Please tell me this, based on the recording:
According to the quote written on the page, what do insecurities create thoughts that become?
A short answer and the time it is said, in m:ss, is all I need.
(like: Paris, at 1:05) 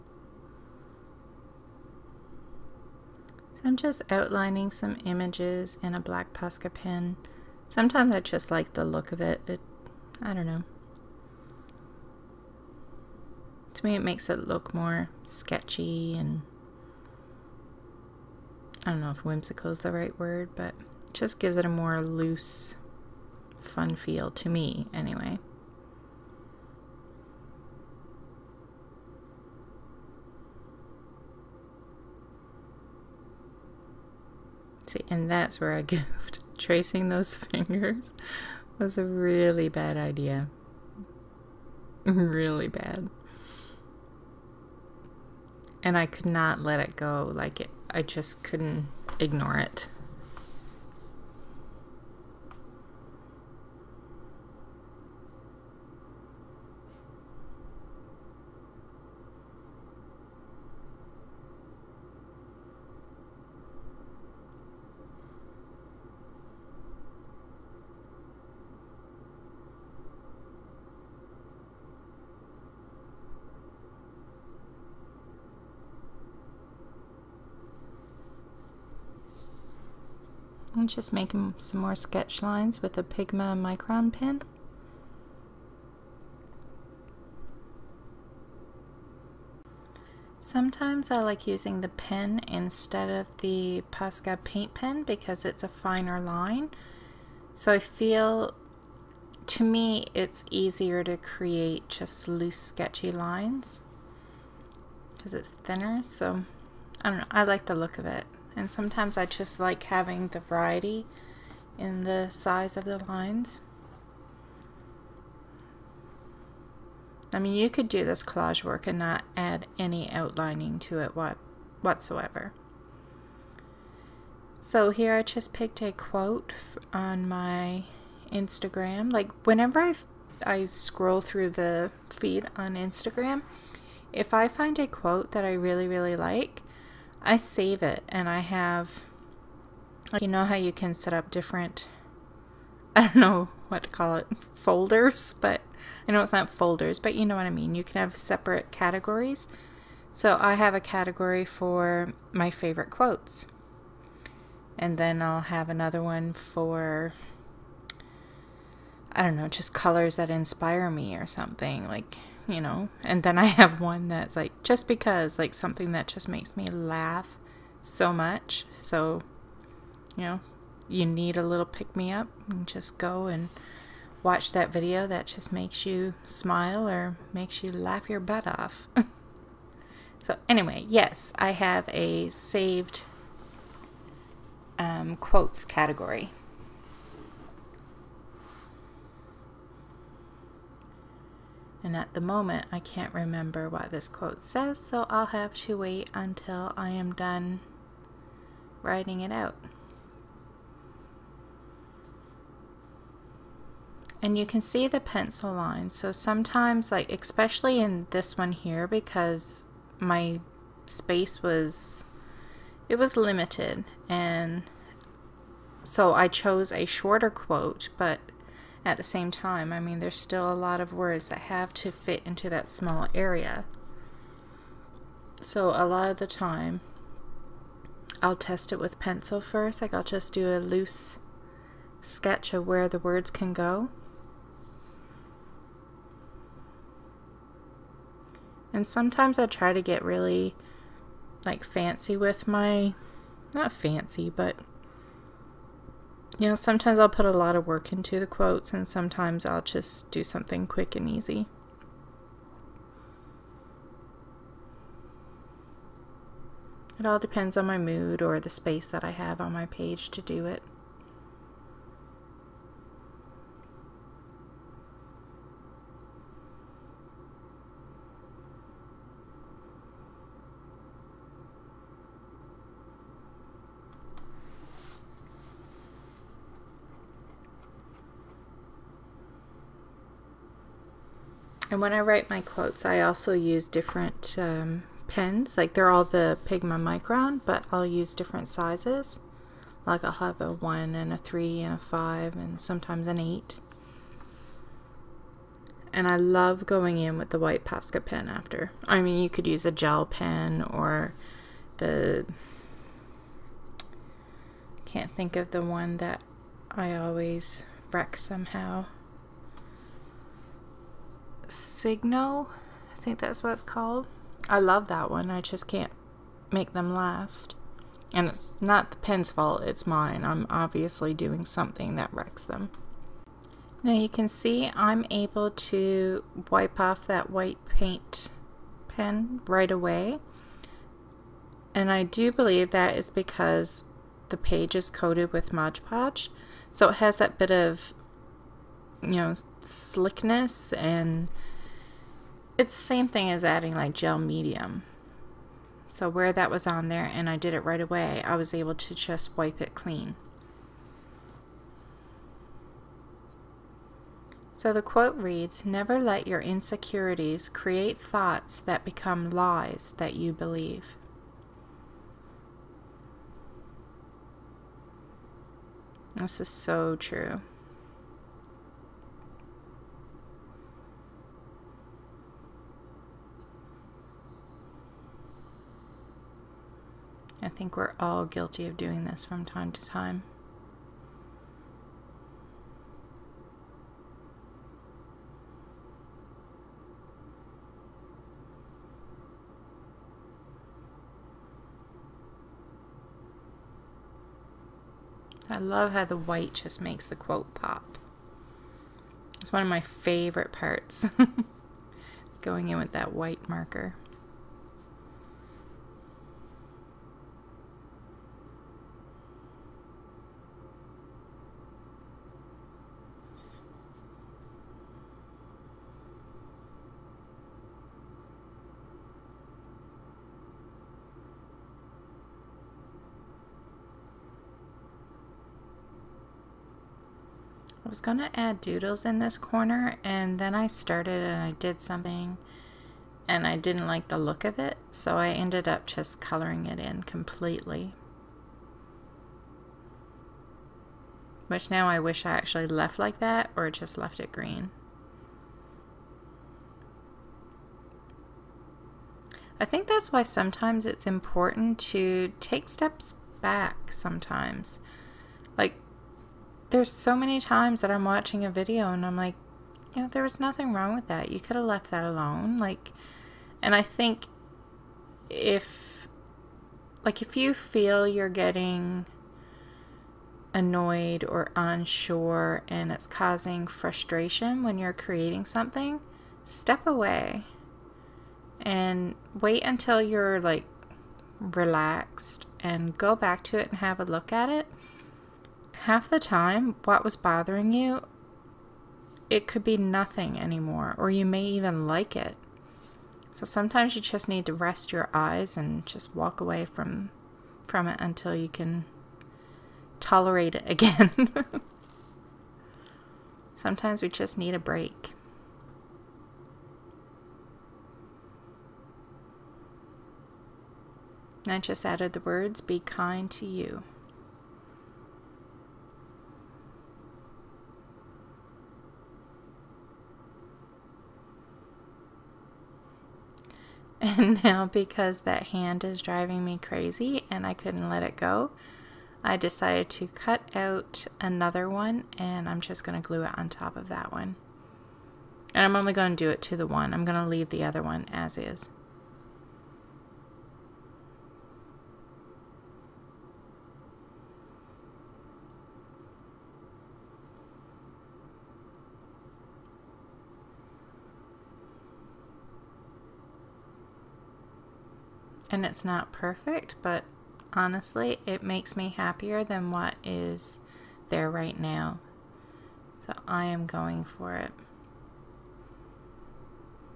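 lies that you believe, at 5:59.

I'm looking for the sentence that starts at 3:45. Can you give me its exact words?
So a lot of the time, I'll test it with pencil first.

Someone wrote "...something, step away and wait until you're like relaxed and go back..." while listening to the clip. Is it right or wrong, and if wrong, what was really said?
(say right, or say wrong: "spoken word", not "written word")
right.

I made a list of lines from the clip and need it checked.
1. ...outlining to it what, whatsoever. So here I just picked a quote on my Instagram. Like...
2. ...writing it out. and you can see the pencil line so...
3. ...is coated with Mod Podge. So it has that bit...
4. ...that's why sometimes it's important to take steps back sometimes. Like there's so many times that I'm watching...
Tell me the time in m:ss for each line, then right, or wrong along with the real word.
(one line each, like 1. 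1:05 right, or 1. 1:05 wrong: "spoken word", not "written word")
1. 2:00 right
2. 3:18 right
3. 5:34 right
4. 7:29 right.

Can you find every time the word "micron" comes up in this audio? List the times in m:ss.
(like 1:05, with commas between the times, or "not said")
1:23, 4:46.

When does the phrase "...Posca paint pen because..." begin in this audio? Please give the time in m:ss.
1:33.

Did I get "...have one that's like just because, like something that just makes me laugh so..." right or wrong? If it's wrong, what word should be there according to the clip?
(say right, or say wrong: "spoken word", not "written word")
right.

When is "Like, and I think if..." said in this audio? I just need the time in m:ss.
7:42.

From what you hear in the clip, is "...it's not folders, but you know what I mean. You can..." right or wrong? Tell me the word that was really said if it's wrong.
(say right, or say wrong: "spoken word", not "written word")
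right.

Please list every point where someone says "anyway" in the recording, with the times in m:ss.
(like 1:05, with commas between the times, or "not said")
0:24, 3:00.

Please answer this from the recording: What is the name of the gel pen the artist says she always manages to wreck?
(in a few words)
Signo.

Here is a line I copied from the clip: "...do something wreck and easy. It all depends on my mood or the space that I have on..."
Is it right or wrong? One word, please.
wrong.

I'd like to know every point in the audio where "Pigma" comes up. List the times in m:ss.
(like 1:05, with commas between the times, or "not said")
1:23, 4:46.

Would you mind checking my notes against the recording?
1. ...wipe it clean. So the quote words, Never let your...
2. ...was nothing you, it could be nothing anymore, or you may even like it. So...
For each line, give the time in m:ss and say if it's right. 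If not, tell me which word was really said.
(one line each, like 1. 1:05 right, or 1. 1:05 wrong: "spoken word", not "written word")
1. 5:49 wrong: "reads", not "words"
2. 8:07 wrong: "bothering", not "nothing".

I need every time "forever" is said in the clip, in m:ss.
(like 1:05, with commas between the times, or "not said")
not said.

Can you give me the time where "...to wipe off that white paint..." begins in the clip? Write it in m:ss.
5:25.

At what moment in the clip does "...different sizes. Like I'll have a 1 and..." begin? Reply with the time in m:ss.
4:48.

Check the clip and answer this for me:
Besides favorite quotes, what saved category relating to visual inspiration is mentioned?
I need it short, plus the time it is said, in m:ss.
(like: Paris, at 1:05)
colors that inspire me, at 2:39.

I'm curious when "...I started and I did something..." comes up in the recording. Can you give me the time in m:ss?
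7:10.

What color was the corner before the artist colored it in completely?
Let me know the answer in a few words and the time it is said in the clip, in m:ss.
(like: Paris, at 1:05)
green, at 7:24.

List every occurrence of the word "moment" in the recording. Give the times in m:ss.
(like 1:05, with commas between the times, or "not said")
3:12.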